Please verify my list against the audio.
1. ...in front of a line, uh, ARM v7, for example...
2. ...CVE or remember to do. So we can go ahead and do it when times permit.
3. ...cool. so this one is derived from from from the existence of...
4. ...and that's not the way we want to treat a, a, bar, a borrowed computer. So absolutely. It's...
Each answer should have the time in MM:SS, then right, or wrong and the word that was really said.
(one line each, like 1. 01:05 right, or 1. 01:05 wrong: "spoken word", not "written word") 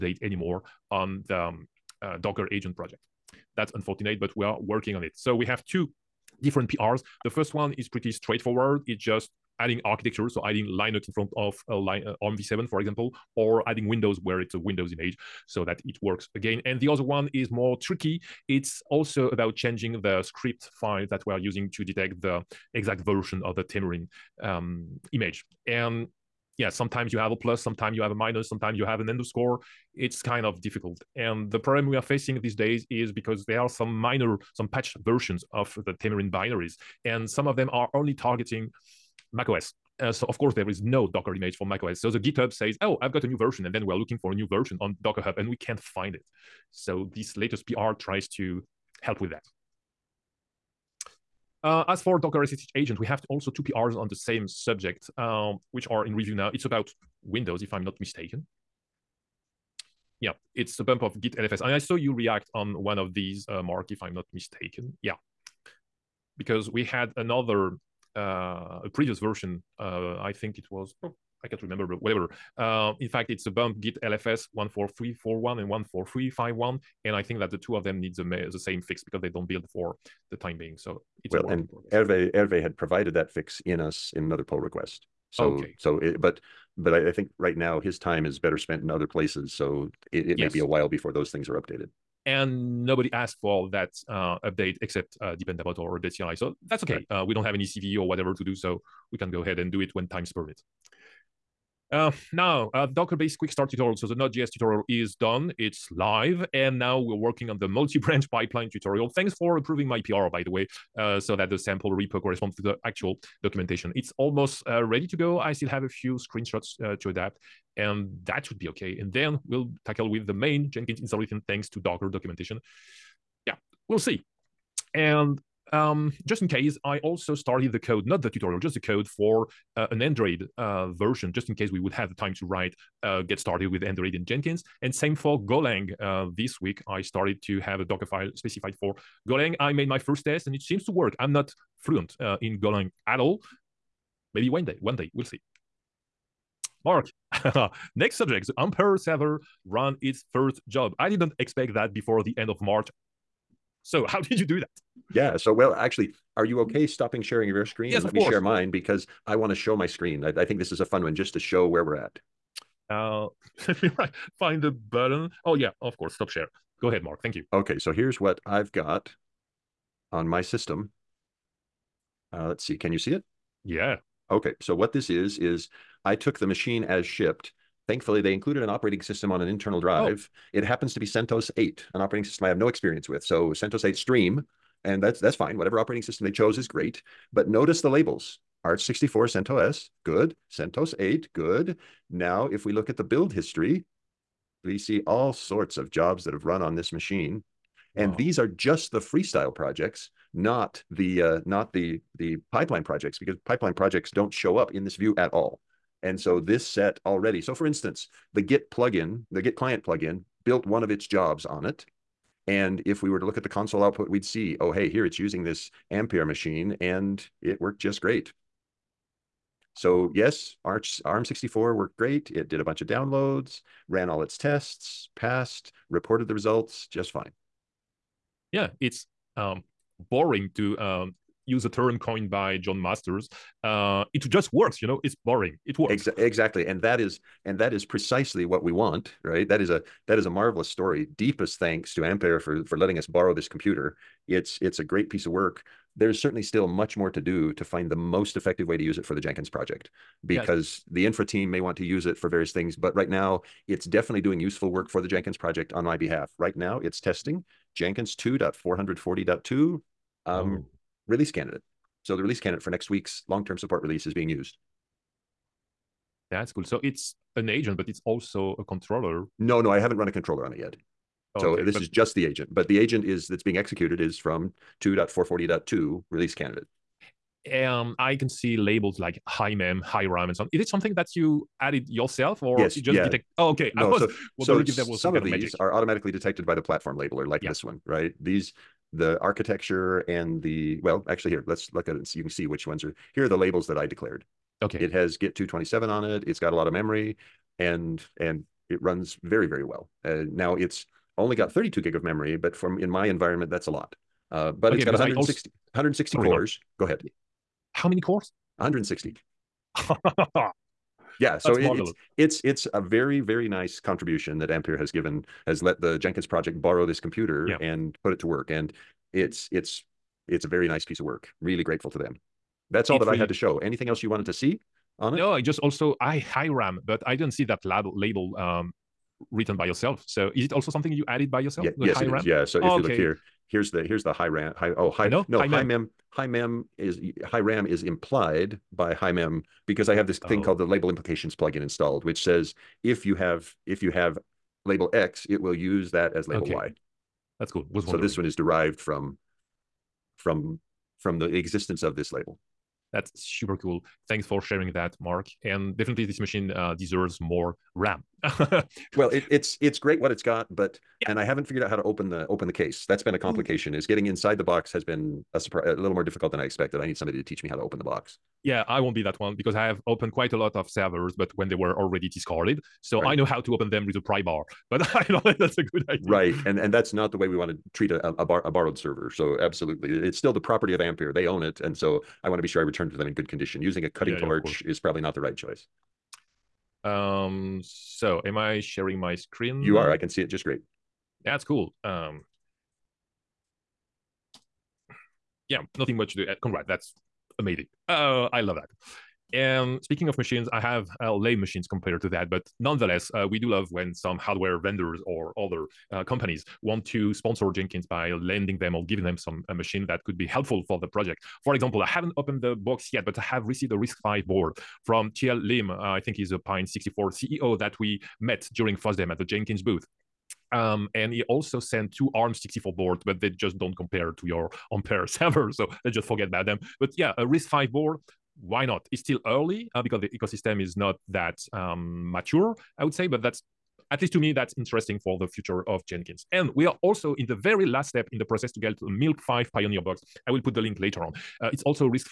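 1. 00:11 right
2. 01:37 wrong: "whatever", not "remember"
3. 05:47 right
4. 06:16 wrong: "server", not "computer".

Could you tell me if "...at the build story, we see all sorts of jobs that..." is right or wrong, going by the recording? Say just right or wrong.
wrong.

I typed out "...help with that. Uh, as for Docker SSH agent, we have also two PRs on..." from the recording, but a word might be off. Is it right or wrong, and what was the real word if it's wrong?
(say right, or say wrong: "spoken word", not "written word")
right.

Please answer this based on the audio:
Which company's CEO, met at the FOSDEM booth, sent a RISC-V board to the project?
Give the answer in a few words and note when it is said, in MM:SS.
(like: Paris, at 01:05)
Pine 64, at 06:56.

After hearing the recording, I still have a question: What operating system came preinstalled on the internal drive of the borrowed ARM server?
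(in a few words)
CentOS 8 Stream.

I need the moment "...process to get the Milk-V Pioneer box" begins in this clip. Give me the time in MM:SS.
07:18.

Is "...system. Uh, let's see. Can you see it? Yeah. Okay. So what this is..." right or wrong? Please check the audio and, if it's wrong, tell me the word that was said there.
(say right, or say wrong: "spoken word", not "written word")
right.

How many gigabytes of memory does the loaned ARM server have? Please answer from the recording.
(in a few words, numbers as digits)
32.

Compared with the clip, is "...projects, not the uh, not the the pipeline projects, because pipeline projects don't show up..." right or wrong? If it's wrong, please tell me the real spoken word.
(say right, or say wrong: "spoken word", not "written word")
right.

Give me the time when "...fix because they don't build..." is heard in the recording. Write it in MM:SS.
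01:18.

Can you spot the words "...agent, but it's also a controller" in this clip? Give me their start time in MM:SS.
04:27.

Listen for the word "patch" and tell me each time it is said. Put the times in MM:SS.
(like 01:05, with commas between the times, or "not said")
00:34.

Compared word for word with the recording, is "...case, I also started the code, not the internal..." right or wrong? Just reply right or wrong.
wrong.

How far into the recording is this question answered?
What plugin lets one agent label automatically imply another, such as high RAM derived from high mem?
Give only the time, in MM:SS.
05:40.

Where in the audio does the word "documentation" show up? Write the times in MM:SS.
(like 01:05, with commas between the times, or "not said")
01:53, 02:02.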